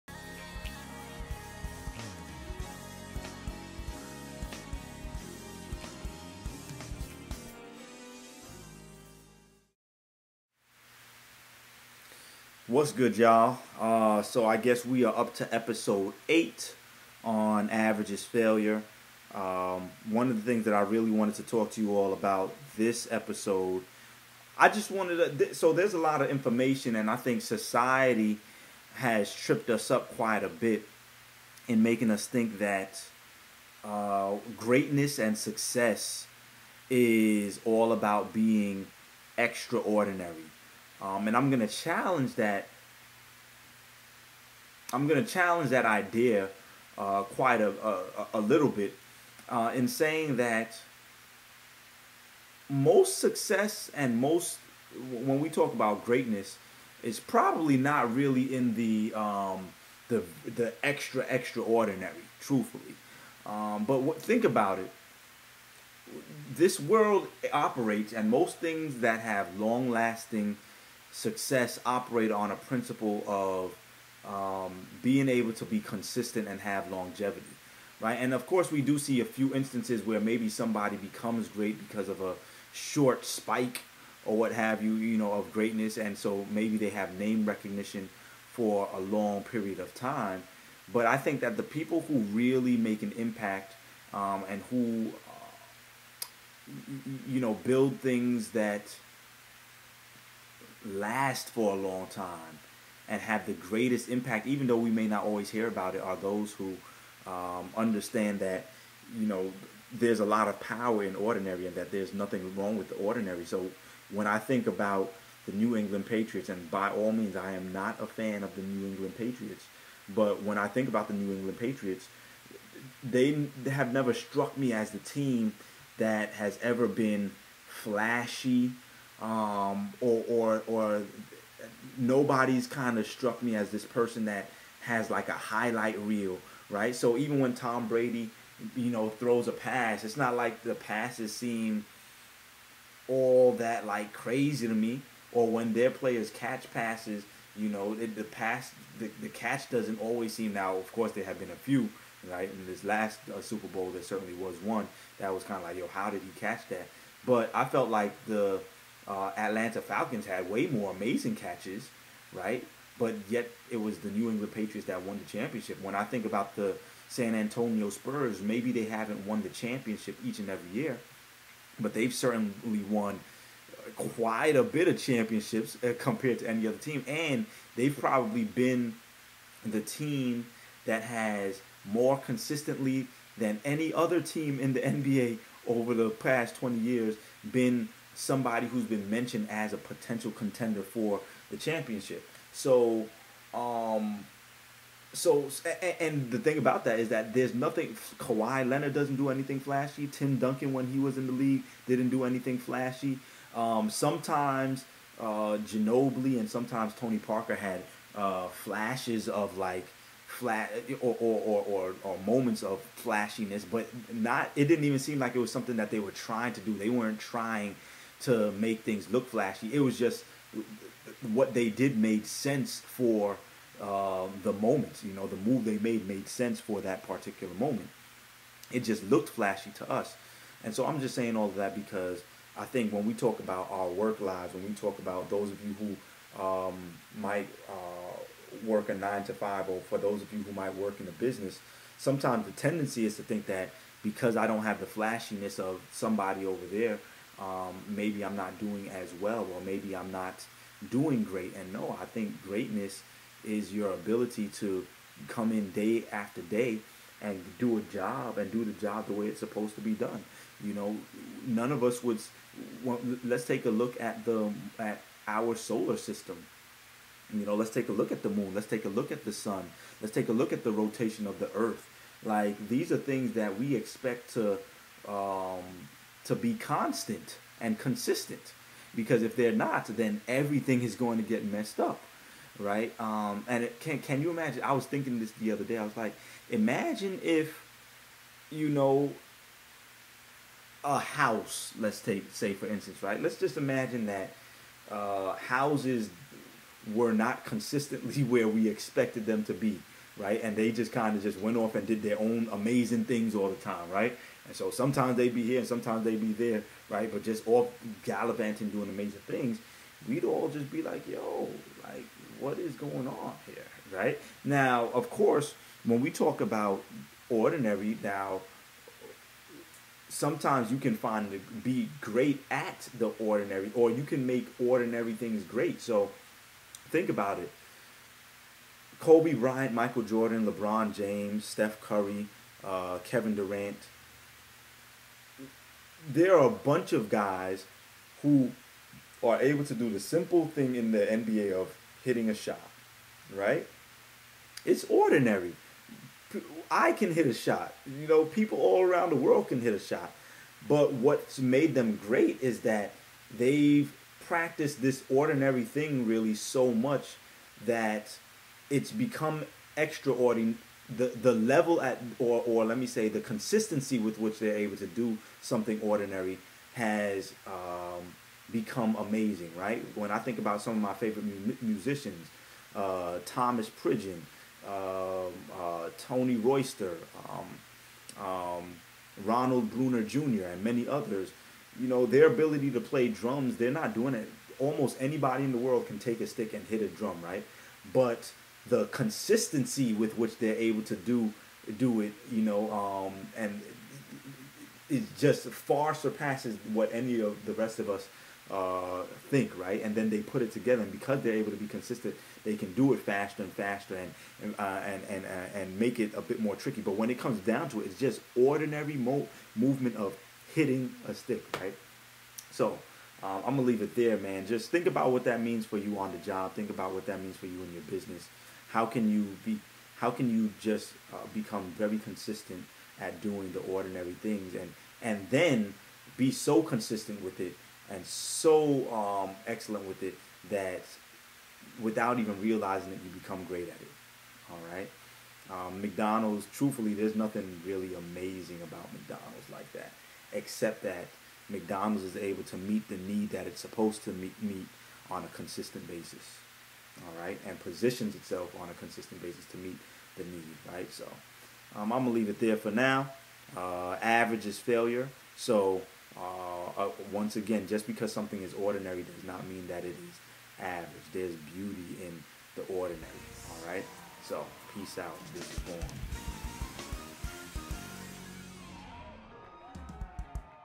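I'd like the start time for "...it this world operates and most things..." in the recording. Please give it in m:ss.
1:04.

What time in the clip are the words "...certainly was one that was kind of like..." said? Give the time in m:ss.
2:34.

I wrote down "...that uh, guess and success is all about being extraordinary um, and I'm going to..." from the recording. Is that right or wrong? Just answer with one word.
wrong.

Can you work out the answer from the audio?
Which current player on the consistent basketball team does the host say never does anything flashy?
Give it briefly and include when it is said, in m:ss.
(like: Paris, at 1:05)
Kawhi Leonard, at 3:18.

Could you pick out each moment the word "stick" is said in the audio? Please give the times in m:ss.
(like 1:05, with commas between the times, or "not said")
6:26, 6:51.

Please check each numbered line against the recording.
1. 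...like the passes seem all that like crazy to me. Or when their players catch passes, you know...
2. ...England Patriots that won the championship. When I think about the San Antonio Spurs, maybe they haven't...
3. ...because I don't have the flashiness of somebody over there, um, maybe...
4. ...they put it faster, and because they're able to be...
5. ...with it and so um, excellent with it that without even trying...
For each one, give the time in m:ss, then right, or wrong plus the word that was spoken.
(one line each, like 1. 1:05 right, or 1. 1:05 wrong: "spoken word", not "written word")
1. 2:20 right
2. 2:44 right
3. 4:04 right
4. 6:40 wrong: "together", not "faster"
5. 7:07 wrong: "realizing", not "trying".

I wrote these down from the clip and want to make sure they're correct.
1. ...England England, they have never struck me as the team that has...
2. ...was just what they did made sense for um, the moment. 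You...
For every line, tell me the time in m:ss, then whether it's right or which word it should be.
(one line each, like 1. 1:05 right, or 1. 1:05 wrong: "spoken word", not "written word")
1. 2:01 wrong: "Patriots", not "England"
2. 3:39 right.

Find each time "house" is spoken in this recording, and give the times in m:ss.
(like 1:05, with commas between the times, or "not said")
4:50, 4:55.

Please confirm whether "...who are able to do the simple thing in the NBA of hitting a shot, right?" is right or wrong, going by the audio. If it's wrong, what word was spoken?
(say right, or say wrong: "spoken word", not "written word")
right.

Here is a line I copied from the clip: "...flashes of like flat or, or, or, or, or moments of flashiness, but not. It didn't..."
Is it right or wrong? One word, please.
right.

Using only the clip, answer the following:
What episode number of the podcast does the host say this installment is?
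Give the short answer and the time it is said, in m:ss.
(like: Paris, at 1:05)
8, at 0:15.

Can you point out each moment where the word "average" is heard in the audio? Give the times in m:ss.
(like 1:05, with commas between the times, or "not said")
0:17, 7:34, 7:40.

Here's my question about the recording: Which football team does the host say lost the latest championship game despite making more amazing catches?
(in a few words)
Atlanta Falcons.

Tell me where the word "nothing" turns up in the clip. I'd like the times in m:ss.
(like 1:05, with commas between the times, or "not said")
1:52, 3:17, 7:17.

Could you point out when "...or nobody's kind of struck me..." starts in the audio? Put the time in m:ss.
2:10.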